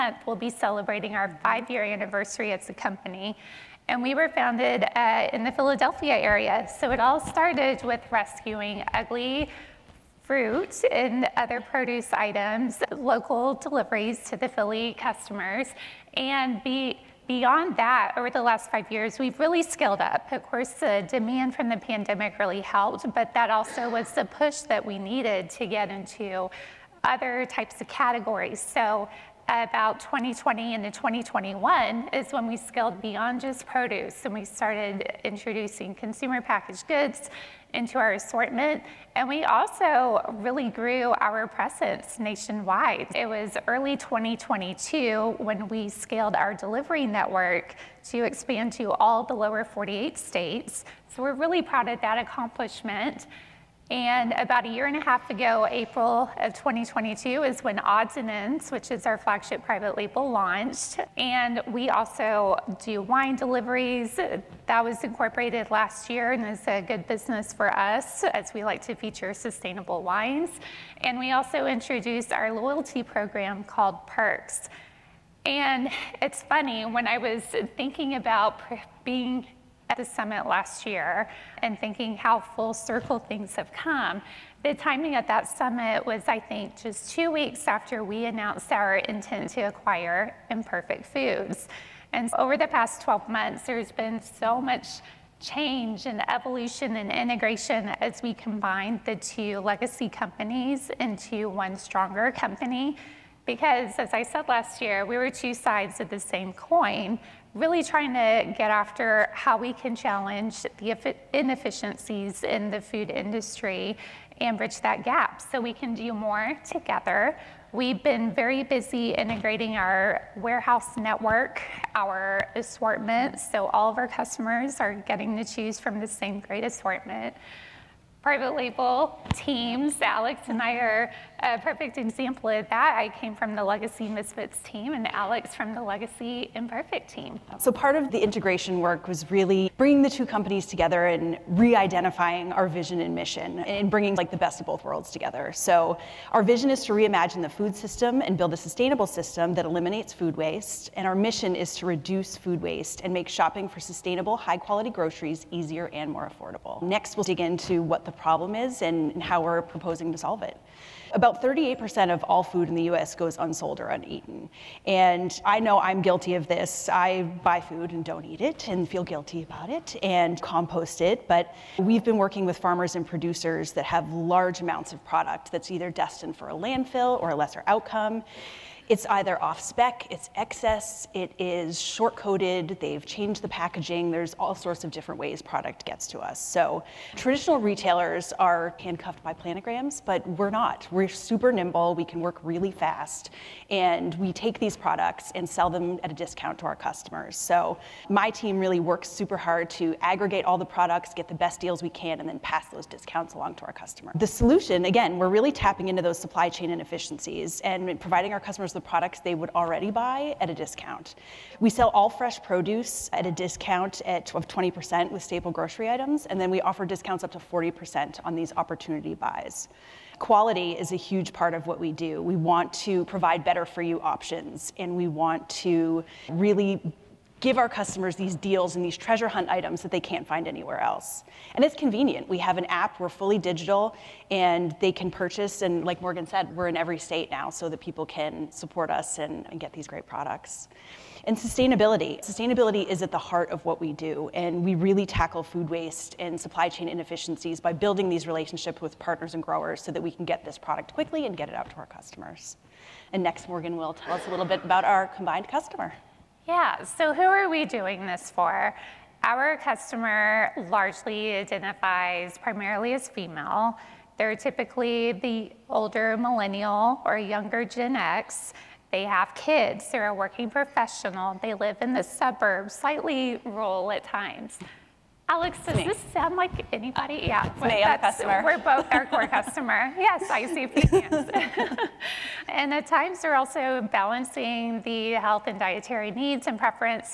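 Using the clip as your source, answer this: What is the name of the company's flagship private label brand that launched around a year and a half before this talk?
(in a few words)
Odds and Ends.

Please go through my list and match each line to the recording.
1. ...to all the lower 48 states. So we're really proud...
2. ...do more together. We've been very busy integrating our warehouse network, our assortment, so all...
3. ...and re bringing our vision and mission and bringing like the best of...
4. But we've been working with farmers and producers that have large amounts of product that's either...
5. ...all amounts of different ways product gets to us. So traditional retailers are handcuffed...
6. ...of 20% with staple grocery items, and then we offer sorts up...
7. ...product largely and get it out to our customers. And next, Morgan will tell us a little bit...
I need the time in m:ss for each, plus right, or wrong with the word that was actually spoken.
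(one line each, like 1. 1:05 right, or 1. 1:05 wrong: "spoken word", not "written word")
1. 0:48 right
2. 1:55 right
3. 2:21 wrong: "identifying", not "bringing"
4. 2:51 right
5. 3:04 wrong: "sorts", not "amounts"
6. 3:34 wrong: "discounts", not "sorts"
7. 4:10 wrong: "quickly", not "largely".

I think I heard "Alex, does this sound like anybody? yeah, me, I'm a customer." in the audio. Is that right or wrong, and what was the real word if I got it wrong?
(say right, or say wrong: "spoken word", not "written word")
right.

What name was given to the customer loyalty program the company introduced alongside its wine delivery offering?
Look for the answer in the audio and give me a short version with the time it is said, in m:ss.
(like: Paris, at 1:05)
Perks, at 1:14.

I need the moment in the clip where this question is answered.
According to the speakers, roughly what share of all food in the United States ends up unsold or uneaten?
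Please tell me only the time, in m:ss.
2:41.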